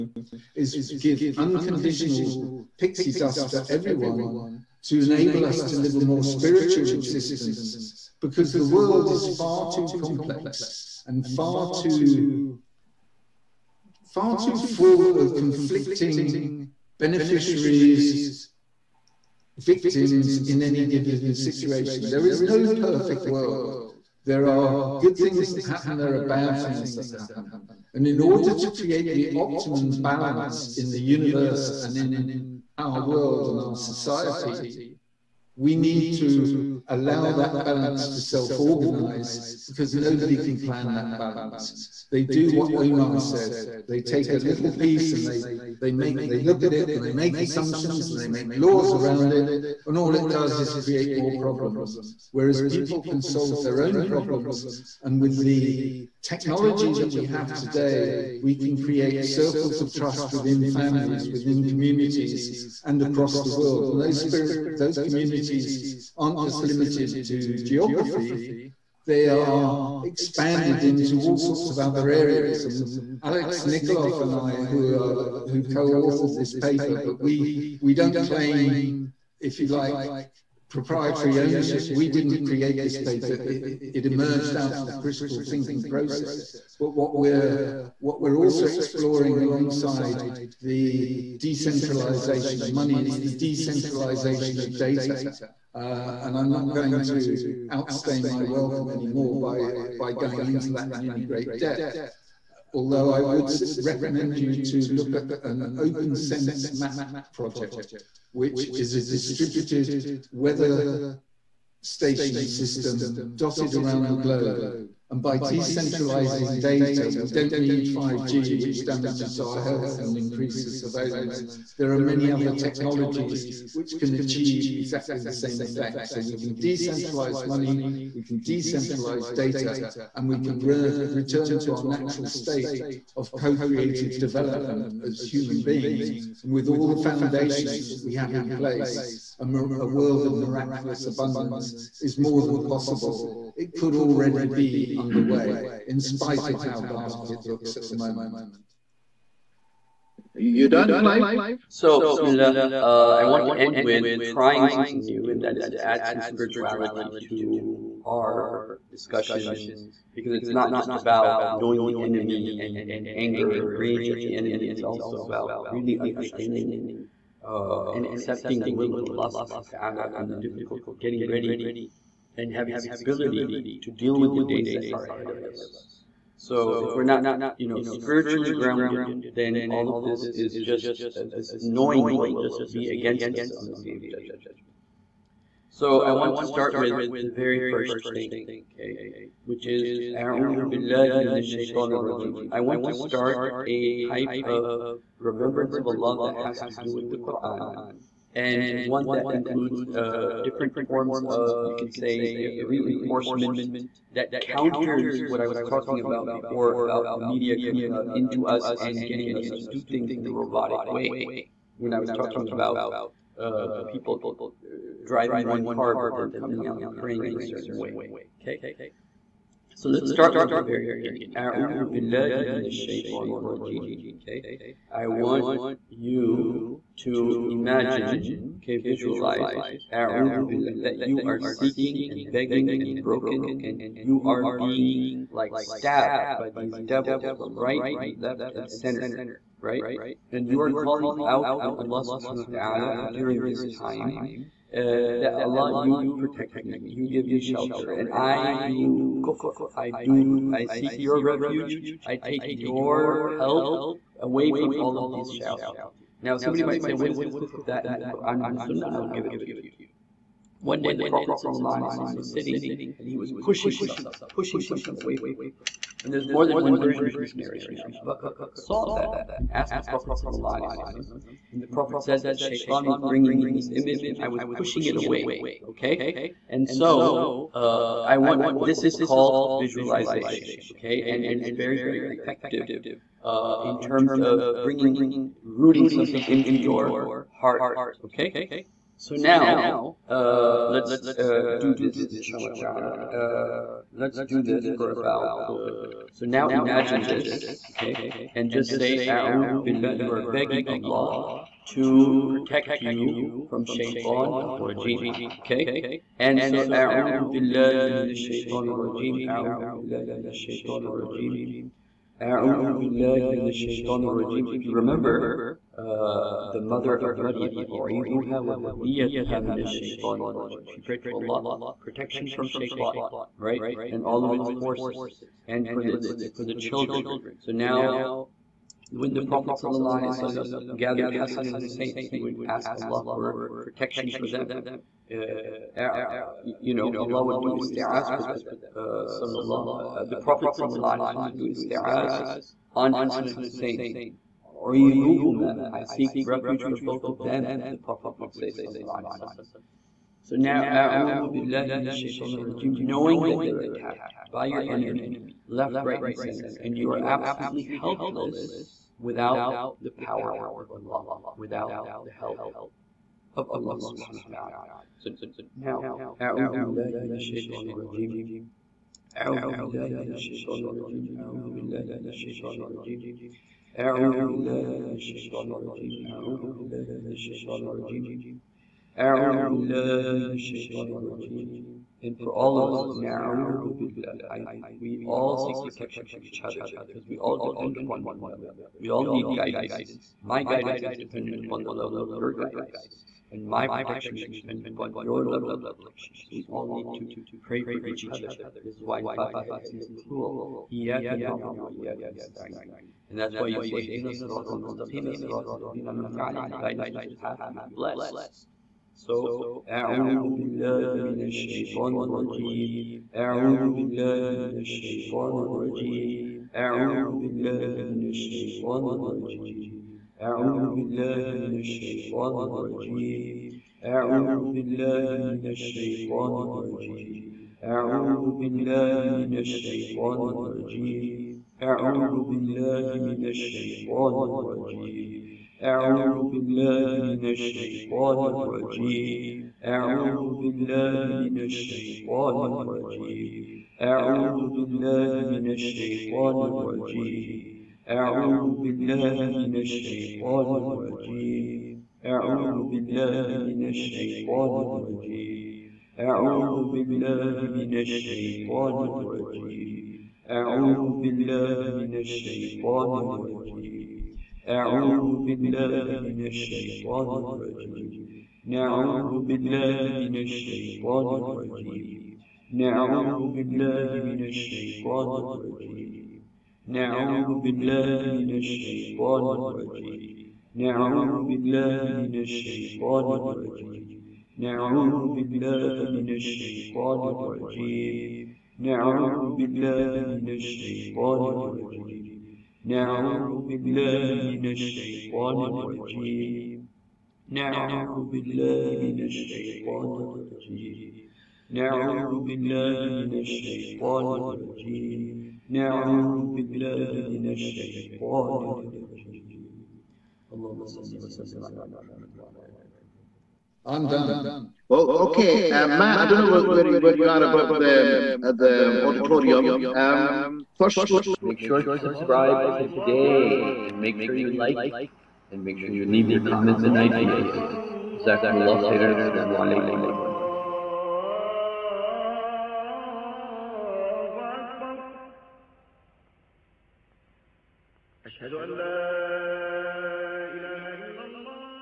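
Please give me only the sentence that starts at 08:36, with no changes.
I don't know where you, where you are about the uh, the auditorium.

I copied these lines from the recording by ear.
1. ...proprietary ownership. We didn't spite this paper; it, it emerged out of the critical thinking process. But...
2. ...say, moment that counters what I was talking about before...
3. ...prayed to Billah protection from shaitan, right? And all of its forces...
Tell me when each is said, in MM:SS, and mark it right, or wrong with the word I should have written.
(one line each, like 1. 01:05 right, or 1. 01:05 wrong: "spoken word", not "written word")
1. 01:20 wrong: "create", not "spite"
2. 03:21 wrong: "reinforcement", not "moment"
3. 05:20 wrong: "Allah", not "Billah".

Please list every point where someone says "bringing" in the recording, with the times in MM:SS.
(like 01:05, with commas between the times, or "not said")
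04:32, 04:44.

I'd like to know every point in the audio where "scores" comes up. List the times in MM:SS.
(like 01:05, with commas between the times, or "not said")
not said.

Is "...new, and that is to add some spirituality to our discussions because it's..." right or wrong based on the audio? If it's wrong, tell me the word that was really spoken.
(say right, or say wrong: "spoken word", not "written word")
right.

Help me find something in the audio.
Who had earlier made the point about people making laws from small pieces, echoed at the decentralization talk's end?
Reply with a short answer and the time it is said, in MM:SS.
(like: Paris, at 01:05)
Omar, at 00:42.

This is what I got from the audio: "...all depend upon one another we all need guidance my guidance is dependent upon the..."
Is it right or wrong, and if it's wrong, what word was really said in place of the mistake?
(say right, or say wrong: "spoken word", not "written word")
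right.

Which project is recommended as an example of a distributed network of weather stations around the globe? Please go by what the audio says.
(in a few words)
openSenseMap.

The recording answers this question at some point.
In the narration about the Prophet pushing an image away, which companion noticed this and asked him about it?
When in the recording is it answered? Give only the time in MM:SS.
04:27.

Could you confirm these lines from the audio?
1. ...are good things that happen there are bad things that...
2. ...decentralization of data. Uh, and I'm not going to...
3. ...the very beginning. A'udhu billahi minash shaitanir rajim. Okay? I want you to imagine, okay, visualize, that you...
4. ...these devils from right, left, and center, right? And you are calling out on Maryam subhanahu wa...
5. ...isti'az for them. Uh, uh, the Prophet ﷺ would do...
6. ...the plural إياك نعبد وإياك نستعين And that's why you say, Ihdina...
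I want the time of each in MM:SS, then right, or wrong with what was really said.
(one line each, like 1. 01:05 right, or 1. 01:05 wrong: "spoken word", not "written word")
1. 00:24 right
2. 01:33 right
3. 03:40 right
4. 03:56 wrong: "Allah", not "Maryam"
5. 05:37 right
6. 06:39 right.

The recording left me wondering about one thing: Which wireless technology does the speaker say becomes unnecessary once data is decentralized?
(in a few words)
5G.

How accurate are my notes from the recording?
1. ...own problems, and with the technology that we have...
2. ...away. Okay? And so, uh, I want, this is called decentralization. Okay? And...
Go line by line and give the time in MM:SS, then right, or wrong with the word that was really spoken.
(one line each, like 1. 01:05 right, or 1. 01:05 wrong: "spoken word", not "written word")
1. 00:53 right
2. 04:34 wrong: "visualization", not "decentralization".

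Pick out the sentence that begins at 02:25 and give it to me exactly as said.
in spite of how dark it looks at the moment.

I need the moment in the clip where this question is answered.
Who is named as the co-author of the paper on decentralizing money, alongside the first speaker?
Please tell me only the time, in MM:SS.
01:13.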